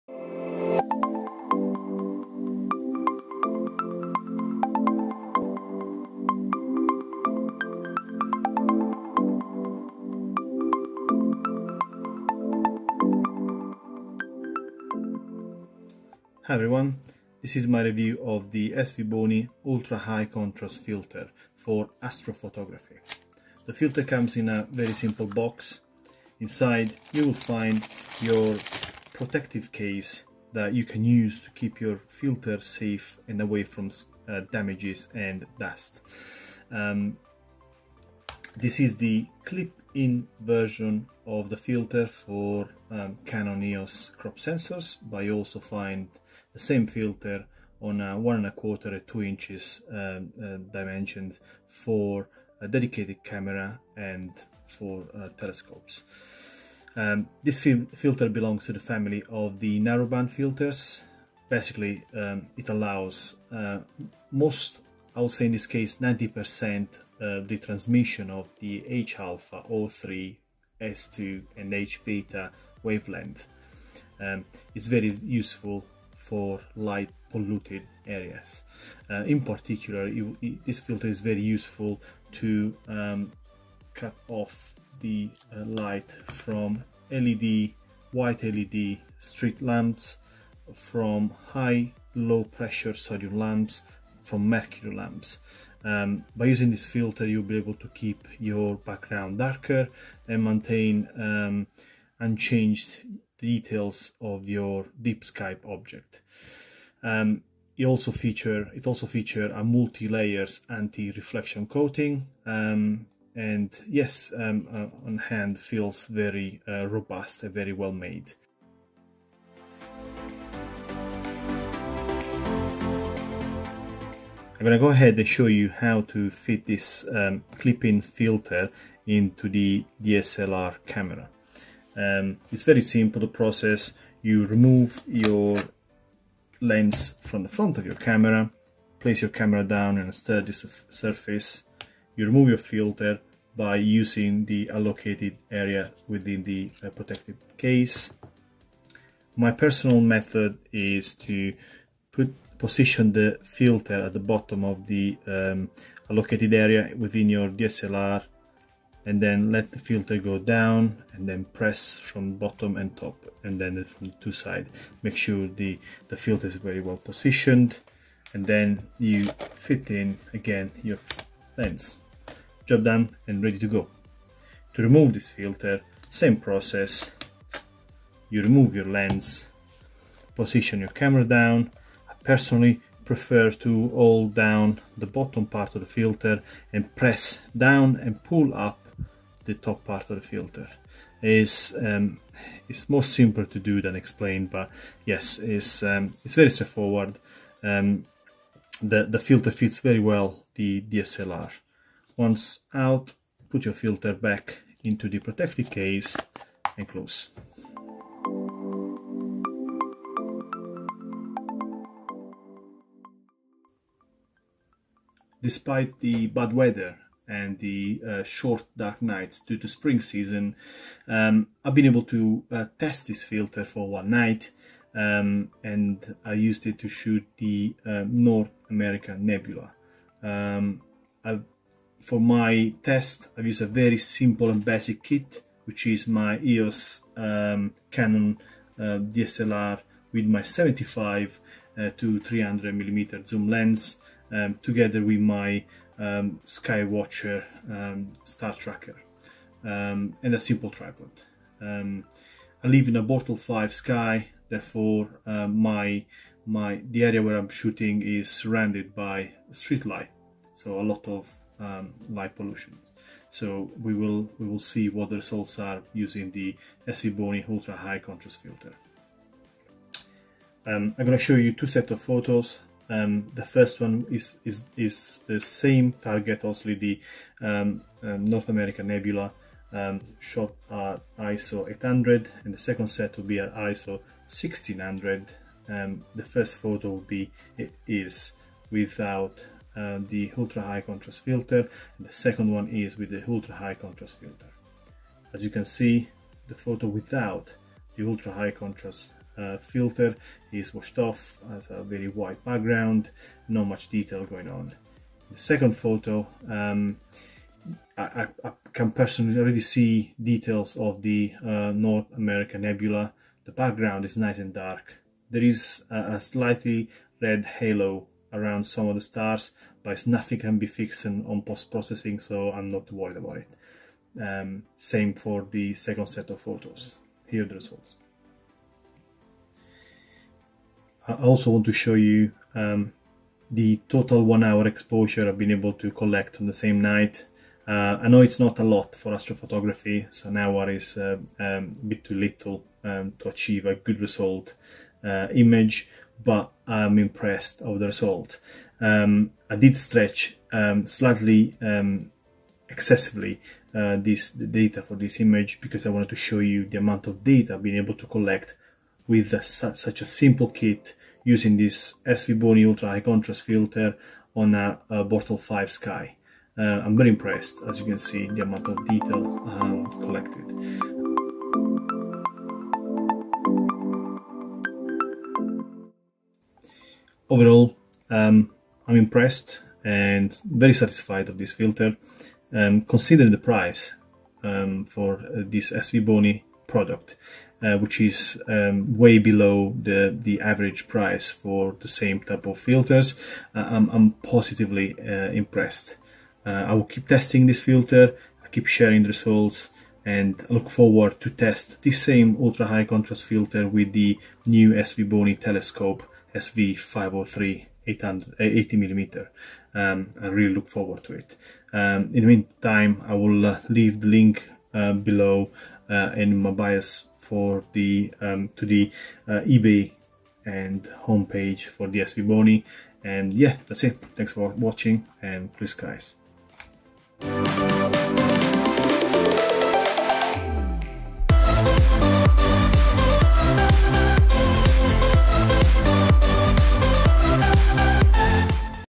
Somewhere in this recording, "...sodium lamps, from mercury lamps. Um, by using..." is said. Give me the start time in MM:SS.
01:32.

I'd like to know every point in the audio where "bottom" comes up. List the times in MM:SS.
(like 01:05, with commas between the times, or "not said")
02:34, 02:42, 03:05.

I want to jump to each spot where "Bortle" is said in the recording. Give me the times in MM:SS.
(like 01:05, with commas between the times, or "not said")
04:13, 06:05.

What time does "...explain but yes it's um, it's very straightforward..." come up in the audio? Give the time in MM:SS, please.
03:13.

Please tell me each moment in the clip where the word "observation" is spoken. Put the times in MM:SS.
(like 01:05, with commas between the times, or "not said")
not said.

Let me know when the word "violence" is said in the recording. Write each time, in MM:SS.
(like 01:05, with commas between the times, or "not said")
not said.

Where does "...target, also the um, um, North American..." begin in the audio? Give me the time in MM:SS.
04:35.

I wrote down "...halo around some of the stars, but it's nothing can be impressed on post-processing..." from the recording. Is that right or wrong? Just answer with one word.
wrong.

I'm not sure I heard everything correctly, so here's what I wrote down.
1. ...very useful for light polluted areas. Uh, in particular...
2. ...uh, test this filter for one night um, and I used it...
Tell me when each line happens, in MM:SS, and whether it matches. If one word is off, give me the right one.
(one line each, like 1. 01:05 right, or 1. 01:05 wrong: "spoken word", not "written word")
1. 01:14 right
2. 03:42 right.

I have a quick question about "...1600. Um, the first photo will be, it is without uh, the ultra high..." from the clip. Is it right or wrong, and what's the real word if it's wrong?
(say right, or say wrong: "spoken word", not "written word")
right.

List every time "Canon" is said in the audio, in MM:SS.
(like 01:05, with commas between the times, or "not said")
00:43, 03:57.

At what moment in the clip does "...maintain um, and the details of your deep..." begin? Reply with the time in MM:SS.
01:40.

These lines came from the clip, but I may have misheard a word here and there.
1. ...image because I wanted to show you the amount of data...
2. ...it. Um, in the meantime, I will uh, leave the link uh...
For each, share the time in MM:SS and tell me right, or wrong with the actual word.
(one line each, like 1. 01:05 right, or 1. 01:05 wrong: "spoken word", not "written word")
1. 05:55 right
2. 06:51 right.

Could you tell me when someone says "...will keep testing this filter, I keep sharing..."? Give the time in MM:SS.
06:36.